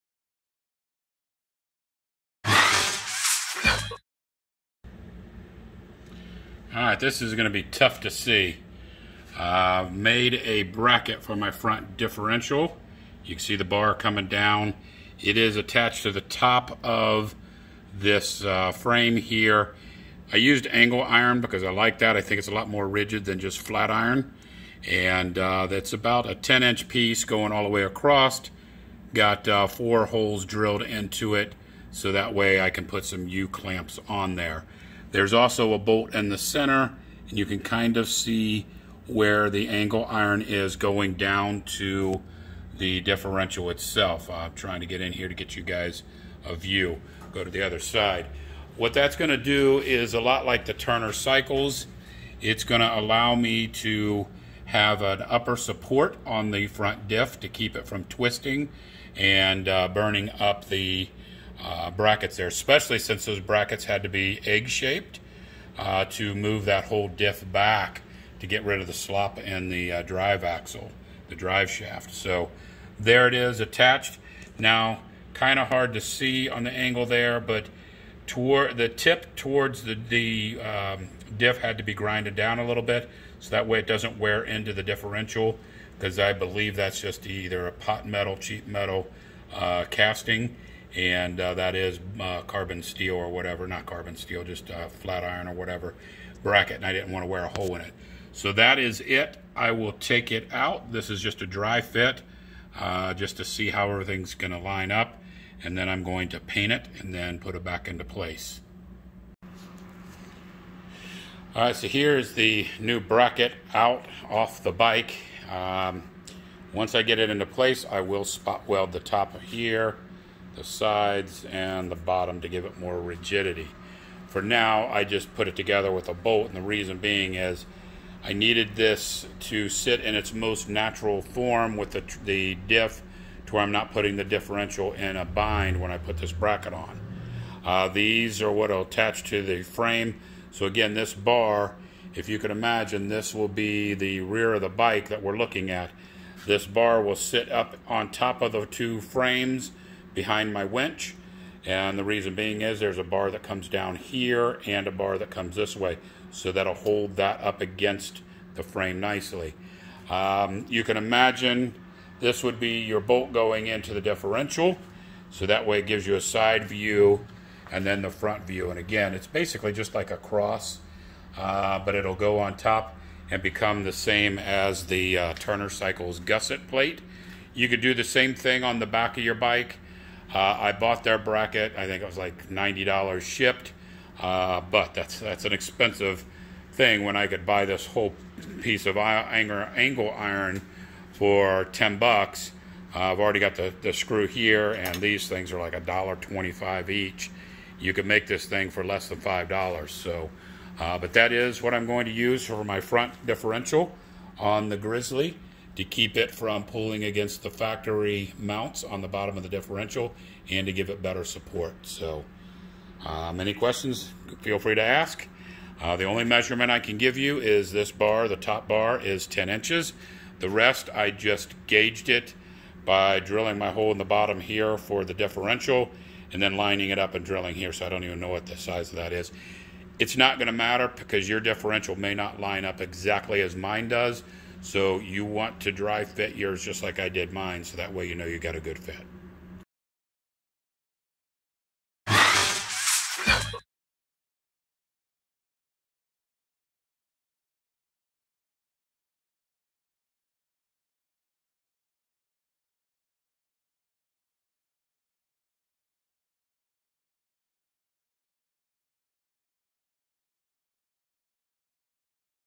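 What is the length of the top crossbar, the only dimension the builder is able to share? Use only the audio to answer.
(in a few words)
10 inches.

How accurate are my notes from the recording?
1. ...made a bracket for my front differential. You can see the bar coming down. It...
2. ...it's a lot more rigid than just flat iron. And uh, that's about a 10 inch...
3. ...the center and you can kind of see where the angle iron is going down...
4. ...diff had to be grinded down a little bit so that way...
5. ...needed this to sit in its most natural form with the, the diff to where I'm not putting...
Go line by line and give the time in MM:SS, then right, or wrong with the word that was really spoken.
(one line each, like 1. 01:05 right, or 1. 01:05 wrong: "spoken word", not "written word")
1. 00:09 right
2. 00:22 right
3. 00:36 right
4. 01:21 right
5. 02:08 right.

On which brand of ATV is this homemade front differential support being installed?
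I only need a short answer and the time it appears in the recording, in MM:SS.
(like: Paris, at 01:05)
Grizzly, at 03:24.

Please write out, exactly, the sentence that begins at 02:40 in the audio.
Um, you can imagine this would be your bolt going into the differential.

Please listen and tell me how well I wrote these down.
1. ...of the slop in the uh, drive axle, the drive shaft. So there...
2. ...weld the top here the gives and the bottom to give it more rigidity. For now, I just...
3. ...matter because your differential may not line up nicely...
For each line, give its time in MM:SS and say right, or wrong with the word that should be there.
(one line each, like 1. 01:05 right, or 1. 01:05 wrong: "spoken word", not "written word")
1. 01:08 right
2. 01:58 wrong: "sides", not "gives"
3. 03:50 wrong: "exactly", not "nicely".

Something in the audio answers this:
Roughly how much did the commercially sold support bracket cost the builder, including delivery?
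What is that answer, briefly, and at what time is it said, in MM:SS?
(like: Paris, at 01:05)
$90, at 03:02.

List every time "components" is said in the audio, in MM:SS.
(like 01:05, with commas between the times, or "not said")
not said.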